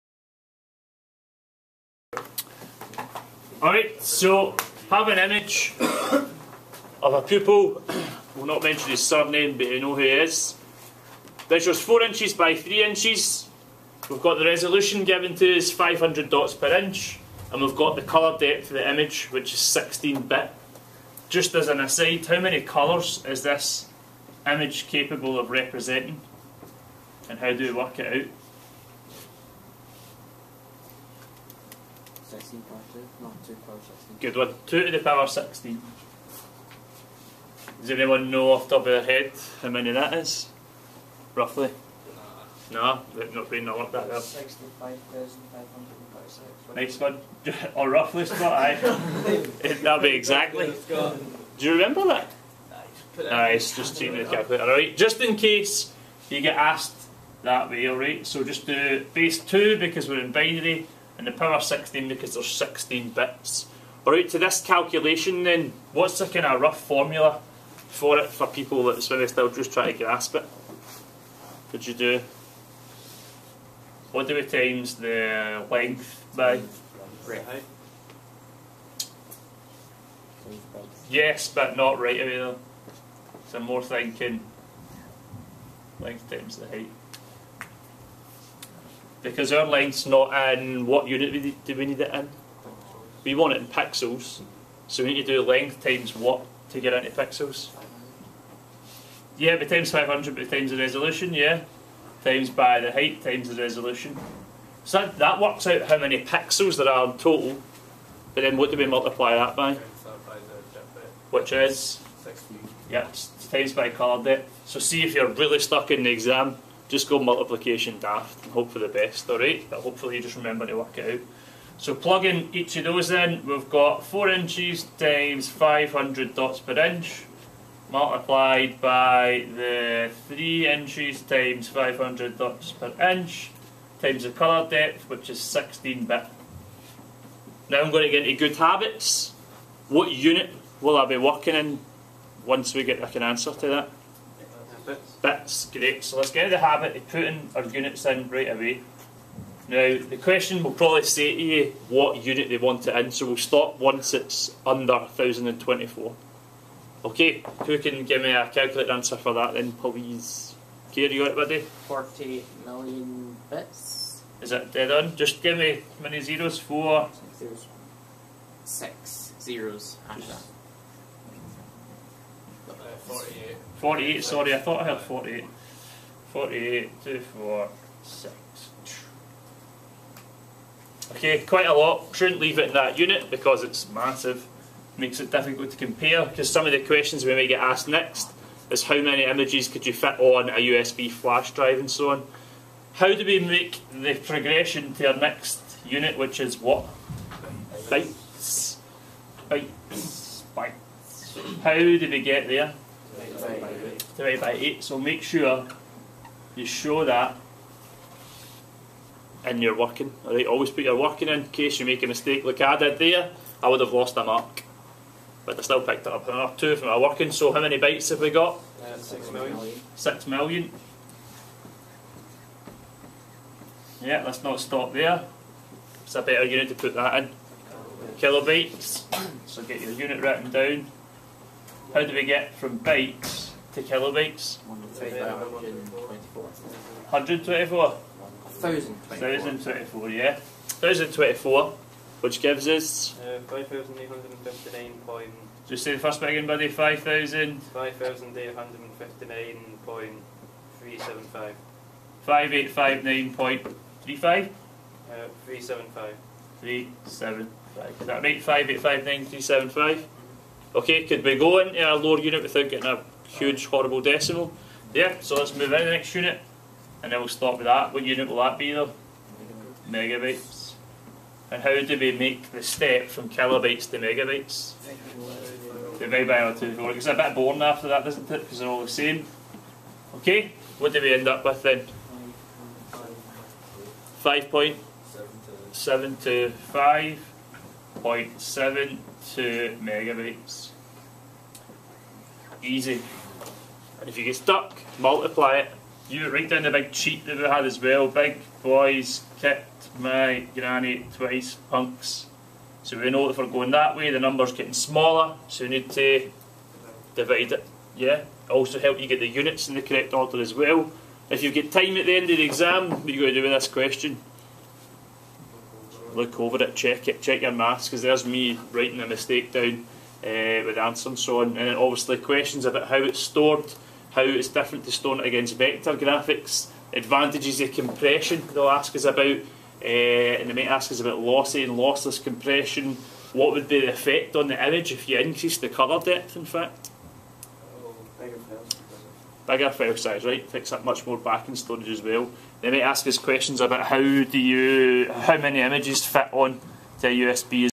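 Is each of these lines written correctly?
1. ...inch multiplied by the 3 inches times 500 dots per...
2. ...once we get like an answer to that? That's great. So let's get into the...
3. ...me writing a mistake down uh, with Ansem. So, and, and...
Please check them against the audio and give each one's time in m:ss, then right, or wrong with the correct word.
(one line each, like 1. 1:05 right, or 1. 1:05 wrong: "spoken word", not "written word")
1. 2:06 right
2. 2:22 right
3. 5:18 right.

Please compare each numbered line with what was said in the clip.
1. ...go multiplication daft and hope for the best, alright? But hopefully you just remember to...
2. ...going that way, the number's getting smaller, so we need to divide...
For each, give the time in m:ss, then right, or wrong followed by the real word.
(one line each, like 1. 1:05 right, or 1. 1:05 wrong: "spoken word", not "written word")
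1. 1:57 right
2. 5:03 right.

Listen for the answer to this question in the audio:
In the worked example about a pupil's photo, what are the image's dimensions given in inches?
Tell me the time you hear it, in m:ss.
0:11.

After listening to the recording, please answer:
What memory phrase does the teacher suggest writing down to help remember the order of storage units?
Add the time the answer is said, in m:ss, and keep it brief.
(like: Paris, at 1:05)
Big boys kicked my granny twice, punks, at 4:58.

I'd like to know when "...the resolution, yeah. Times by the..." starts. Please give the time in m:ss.
1:40.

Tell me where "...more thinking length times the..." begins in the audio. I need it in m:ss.
1:23.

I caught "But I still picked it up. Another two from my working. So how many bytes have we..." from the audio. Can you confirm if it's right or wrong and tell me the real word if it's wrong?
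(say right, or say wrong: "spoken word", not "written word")
right.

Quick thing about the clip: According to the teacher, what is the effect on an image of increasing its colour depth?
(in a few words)
Bigger file size.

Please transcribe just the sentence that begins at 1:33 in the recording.
We want it in pixels, so we need to do length times what to get it into pixels.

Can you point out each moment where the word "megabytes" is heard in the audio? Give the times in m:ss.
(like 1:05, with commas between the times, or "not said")
4:29, 4:33, 4:49.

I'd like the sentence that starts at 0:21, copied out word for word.
Just as an aside, how many colours is this image capable of representing?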